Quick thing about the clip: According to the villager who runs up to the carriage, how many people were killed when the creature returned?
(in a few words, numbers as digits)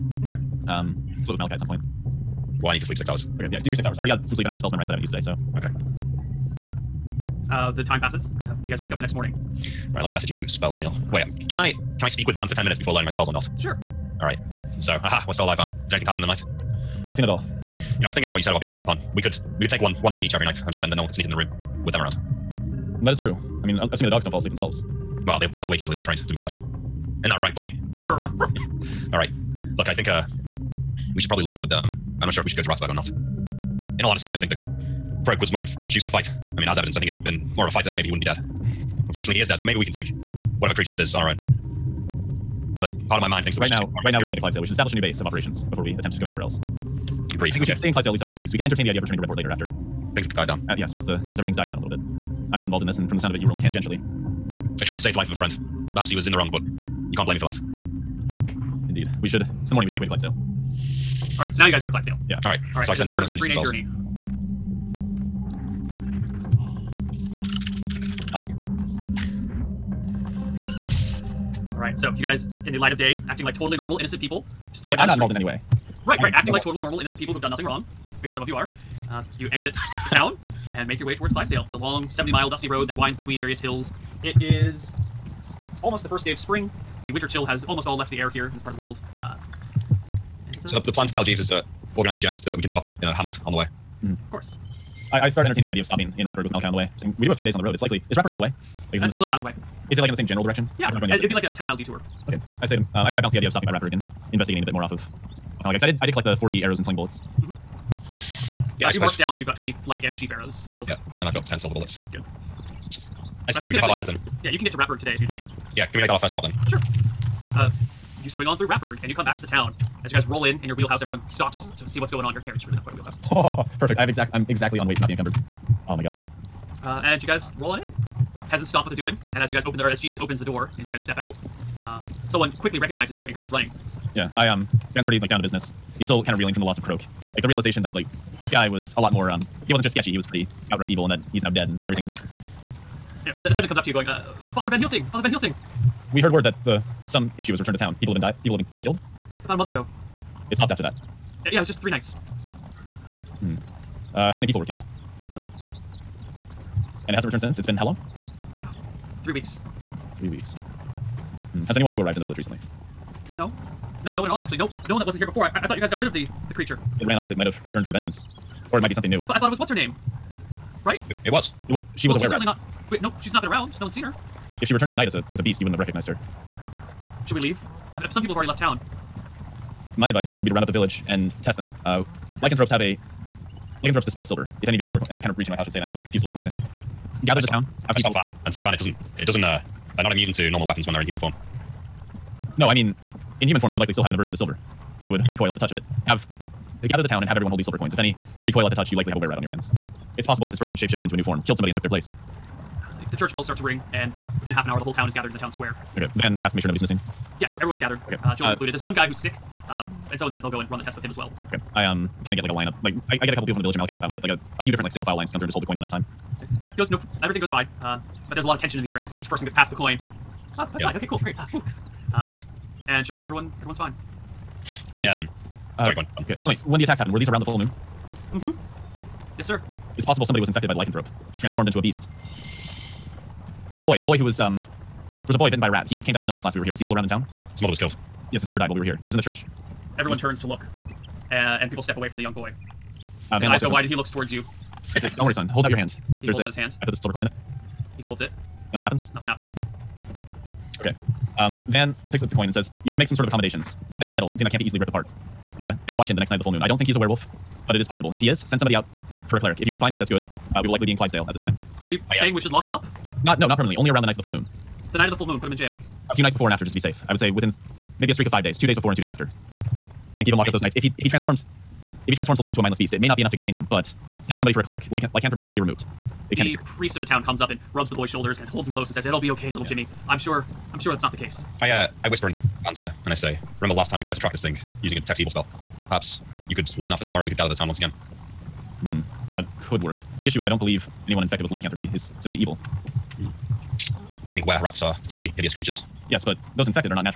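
A dozen.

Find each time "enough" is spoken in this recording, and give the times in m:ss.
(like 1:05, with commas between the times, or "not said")
3:43, 4:33.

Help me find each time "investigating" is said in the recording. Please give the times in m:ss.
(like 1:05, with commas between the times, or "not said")
1:44.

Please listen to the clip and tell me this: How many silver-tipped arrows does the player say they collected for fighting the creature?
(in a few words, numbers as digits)
20.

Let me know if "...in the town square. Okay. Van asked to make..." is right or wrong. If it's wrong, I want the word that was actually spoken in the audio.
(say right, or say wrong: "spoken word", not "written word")
right.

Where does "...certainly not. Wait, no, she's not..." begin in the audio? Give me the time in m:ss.
2:52.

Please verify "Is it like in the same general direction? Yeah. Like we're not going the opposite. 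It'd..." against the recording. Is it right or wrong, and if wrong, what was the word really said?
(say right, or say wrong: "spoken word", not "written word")
right.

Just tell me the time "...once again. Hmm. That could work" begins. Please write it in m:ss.
4:47.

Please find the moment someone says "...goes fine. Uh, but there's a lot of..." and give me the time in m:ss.
3:37.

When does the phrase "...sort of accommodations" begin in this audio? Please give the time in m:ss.
4:13.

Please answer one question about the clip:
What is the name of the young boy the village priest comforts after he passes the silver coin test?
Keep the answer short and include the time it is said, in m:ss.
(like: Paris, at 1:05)
Jimmy, at 4:39.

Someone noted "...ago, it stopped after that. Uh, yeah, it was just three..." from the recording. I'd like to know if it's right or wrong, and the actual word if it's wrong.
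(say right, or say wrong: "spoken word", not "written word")
right.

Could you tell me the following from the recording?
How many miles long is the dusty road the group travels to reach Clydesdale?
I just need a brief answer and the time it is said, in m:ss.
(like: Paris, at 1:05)
70, at 1:22.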